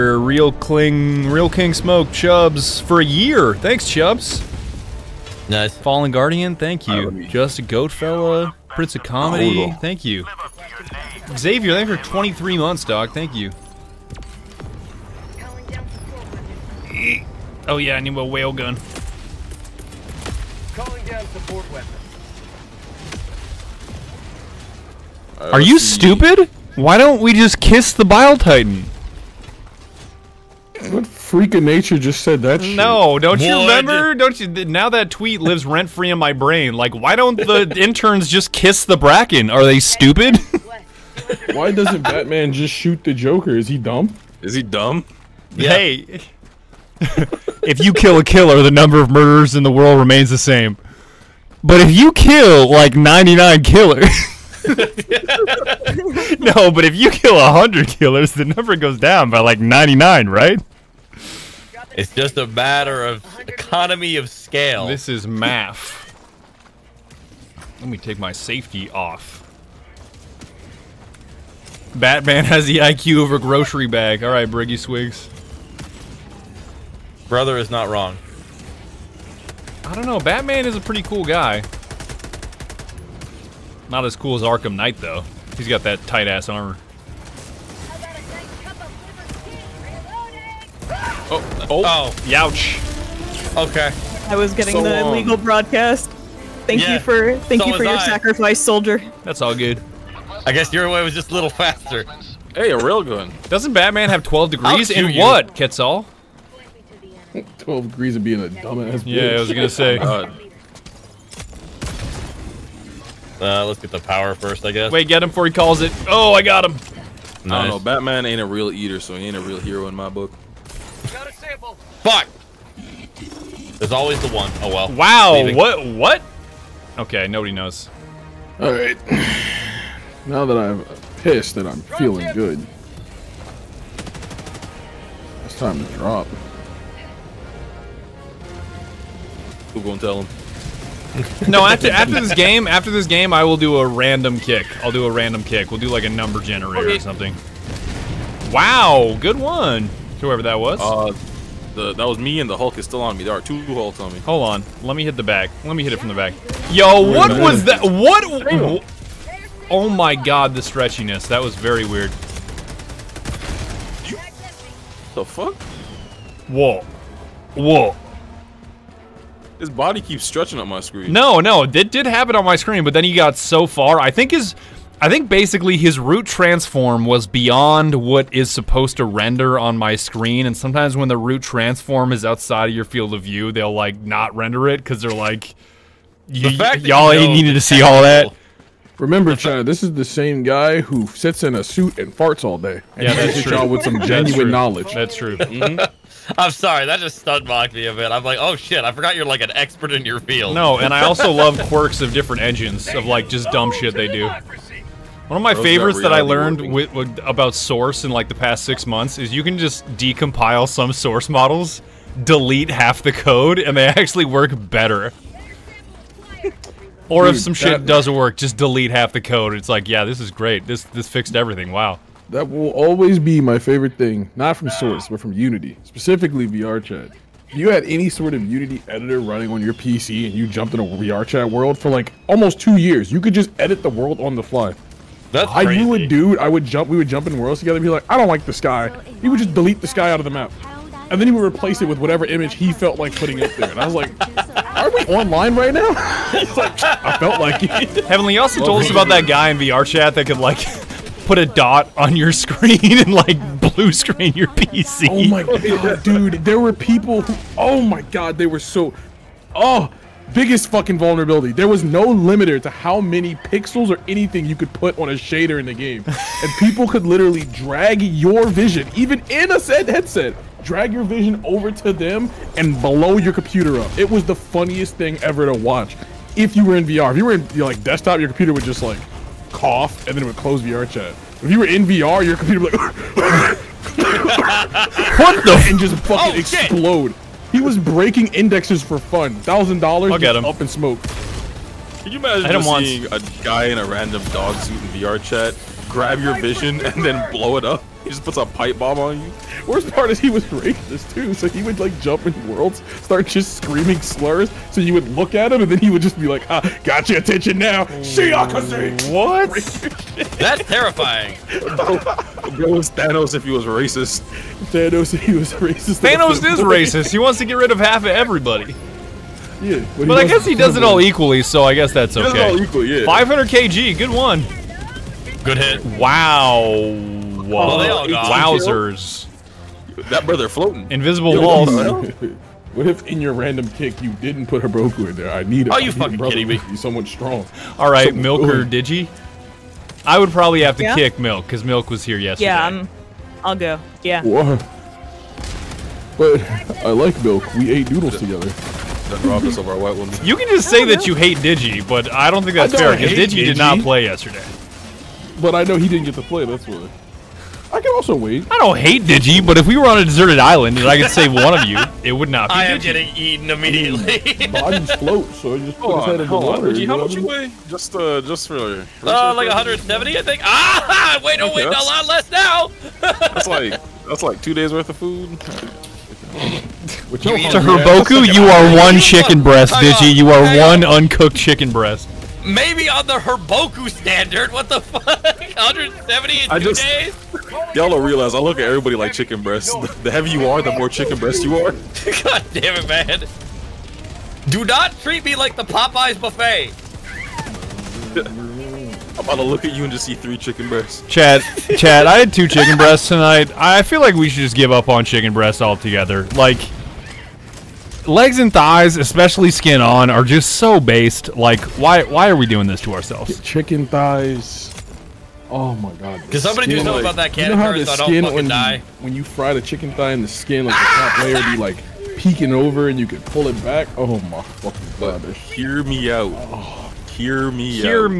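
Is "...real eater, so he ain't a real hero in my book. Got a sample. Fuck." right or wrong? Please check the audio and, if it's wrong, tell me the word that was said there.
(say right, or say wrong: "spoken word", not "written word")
right.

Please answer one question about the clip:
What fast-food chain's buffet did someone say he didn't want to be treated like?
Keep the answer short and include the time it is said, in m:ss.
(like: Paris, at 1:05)
Popeyes, at 6:35.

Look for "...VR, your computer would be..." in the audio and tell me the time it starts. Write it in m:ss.
4:41.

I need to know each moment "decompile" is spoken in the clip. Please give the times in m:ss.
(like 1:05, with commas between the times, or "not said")
3:29.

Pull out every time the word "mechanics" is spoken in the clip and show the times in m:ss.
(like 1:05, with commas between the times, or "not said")
not said.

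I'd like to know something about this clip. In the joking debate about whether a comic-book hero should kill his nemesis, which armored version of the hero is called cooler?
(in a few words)
Arkham Knight.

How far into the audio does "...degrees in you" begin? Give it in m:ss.
1:44.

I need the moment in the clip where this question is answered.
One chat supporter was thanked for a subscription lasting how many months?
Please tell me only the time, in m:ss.
0:12.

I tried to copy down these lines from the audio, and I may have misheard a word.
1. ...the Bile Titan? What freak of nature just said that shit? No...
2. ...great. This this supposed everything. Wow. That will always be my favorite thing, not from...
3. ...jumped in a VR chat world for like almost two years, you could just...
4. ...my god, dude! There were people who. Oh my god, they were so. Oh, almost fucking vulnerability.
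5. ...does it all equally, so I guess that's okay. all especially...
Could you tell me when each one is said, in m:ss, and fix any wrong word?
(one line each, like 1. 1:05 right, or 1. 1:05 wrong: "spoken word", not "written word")
1. 0:27 right
2. 3:40 wrong: "fixed", not "supposed"
3. 3:50 right
4. 4:15 wrong: "biggest", not "almost"
5. 5:20 wrong: "equally", not "especially".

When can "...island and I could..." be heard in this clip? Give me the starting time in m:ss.
6:00.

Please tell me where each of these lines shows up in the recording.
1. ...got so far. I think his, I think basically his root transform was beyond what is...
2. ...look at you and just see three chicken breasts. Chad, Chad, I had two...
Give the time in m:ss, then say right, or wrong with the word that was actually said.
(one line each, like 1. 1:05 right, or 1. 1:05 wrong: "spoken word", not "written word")
1. 2:53 right
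2. 6:39 right.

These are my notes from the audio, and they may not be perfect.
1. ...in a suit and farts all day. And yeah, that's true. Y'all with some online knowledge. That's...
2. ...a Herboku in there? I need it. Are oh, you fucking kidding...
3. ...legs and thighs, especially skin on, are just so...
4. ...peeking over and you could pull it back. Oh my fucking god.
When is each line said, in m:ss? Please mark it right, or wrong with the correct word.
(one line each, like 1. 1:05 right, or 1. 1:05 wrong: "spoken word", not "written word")
1. 3:11 wrong: "genuine", not "online"
2. 5:34 right
3. 6:48 right
4. 7:02 right.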